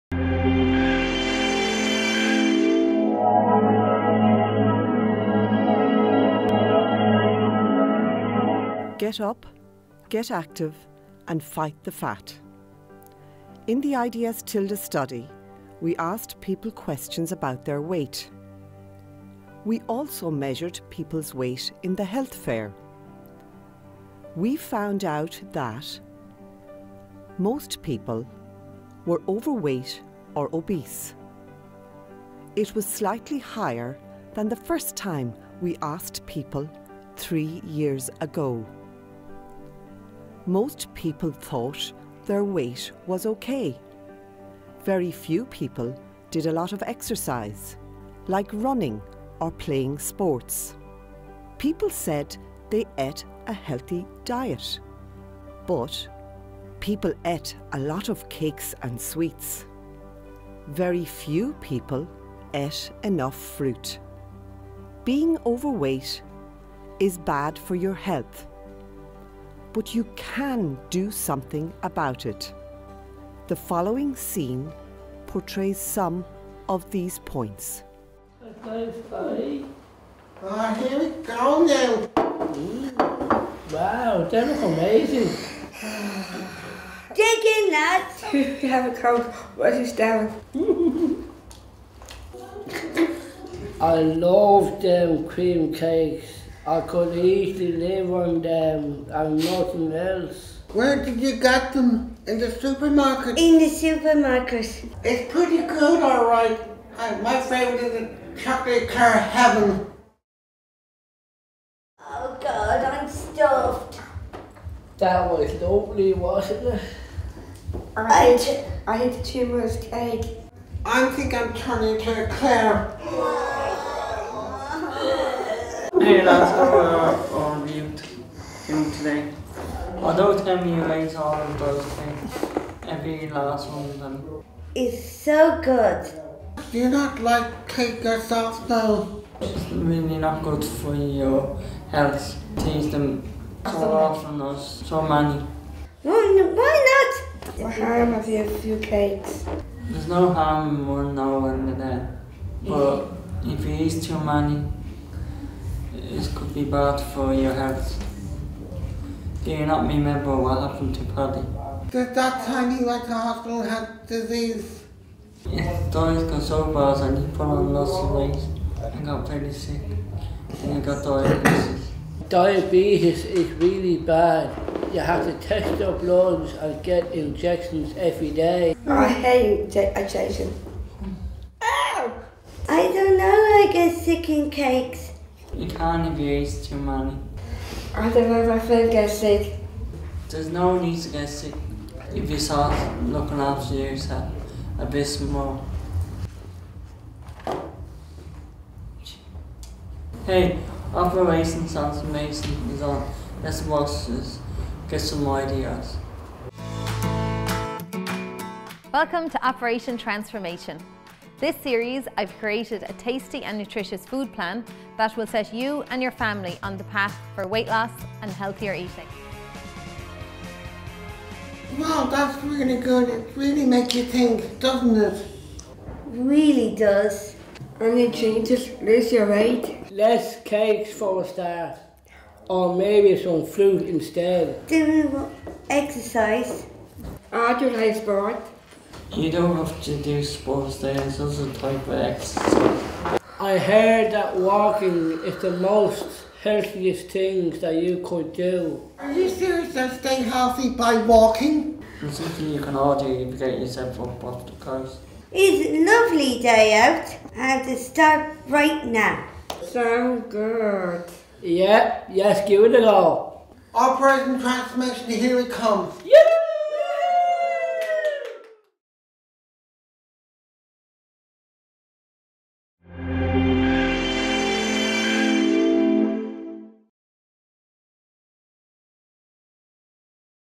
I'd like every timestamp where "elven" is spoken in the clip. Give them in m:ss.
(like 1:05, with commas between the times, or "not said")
not said.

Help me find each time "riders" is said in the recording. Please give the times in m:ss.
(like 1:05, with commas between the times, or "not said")
not said.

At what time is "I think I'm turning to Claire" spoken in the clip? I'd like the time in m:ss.
2:00.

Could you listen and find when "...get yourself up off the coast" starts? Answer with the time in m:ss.
4:13.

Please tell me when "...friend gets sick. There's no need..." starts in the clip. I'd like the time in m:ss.
3:08.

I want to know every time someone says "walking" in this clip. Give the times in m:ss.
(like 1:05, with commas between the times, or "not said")
4:04, 4:11.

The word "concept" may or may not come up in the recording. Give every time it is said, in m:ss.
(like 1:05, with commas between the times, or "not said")
not said.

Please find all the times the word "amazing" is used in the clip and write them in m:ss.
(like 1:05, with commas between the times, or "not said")
1:24.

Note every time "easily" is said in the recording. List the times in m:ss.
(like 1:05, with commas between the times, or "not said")
1:37.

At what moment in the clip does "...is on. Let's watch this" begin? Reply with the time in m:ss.
3:22.